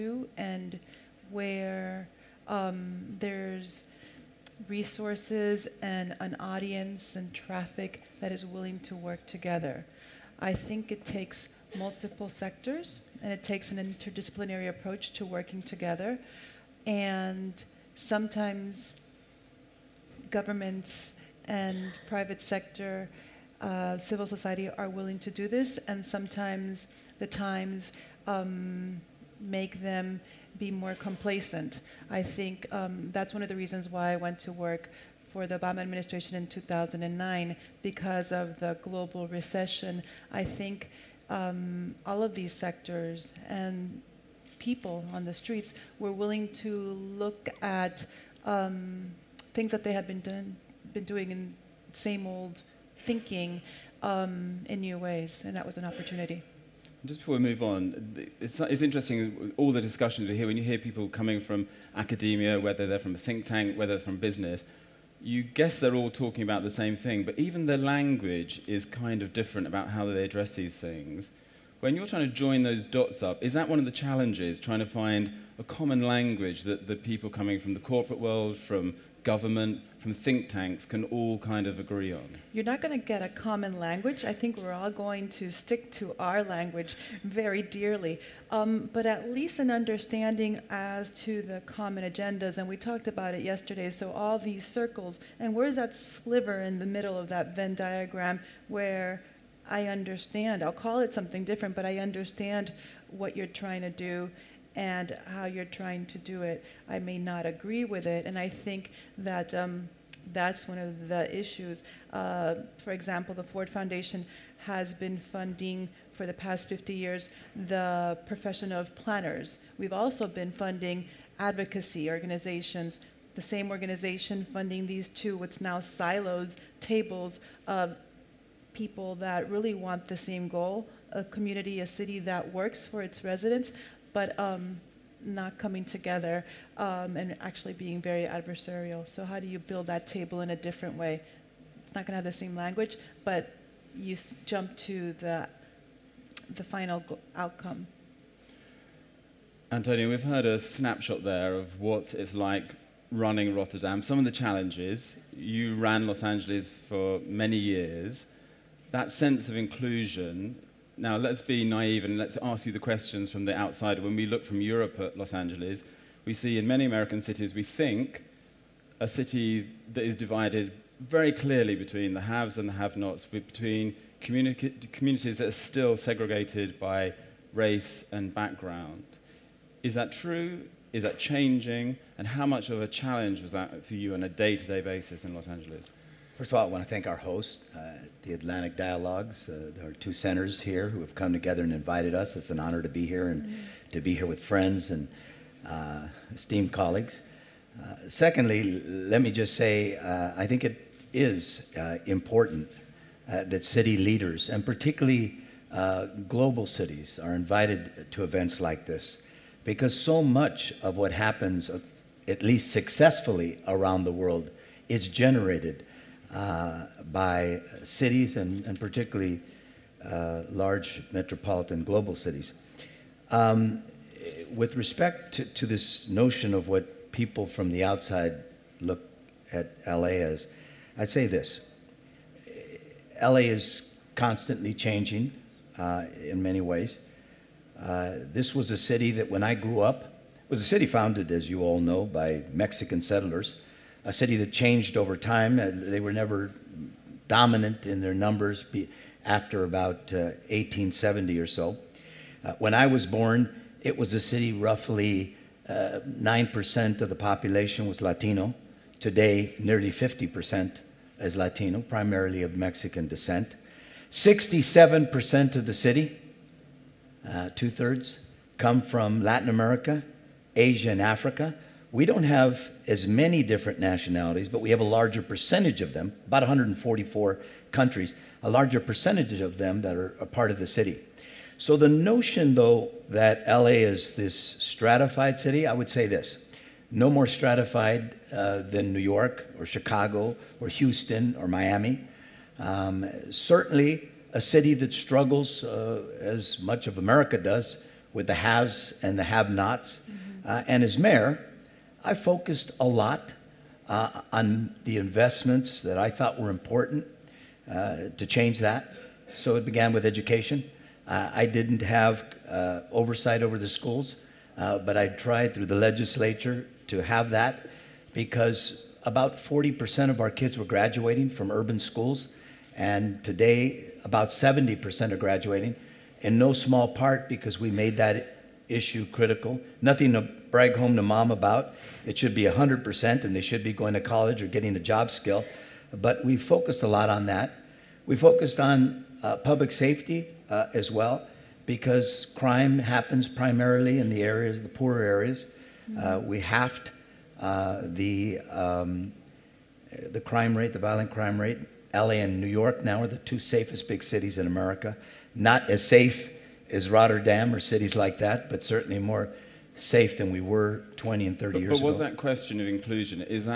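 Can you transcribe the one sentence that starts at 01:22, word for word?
You're not going to get a common language.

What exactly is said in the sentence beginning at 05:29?
Nothing brag home to mom about.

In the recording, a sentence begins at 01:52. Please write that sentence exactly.
Uh, for example, the Ford Foundation has been funding for the past 50 years the profession of planners.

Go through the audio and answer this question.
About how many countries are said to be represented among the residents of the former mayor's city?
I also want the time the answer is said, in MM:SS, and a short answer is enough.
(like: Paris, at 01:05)
144, at 04:36.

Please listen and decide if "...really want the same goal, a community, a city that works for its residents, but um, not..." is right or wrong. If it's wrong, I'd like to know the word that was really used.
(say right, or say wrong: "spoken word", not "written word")
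right.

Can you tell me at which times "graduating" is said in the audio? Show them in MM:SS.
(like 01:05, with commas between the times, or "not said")
05:20, 05:25.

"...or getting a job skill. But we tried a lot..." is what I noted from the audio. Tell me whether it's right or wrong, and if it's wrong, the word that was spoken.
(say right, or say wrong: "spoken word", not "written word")
wrong: "focused", not "tried".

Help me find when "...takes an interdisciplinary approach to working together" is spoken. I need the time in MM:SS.
00:13.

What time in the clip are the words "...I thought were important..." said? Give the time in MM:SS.
05:05.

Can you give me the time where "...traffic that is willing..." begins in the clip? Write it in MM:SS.
00:07.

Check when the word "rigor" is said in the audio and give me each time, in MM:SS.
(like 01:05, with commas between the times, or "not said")
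not said.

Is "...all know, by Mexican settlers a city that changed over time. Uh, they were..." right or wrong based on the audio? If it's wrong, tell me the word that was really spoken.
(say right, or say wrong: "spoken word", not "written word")
right.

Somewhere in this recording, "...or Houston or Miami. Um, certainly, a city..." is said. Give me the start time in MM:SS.
04:50.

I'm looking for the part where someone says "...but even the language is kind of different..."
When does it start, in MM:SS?
01:07.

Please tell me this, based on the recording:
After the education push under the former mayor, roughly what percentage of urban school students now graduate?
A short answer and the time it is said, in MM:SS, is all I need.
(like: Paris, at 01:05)
70%, at 05:24.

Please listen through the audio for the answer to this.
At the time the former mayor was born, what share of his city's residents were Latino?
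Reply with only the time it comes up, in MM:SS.
04:15.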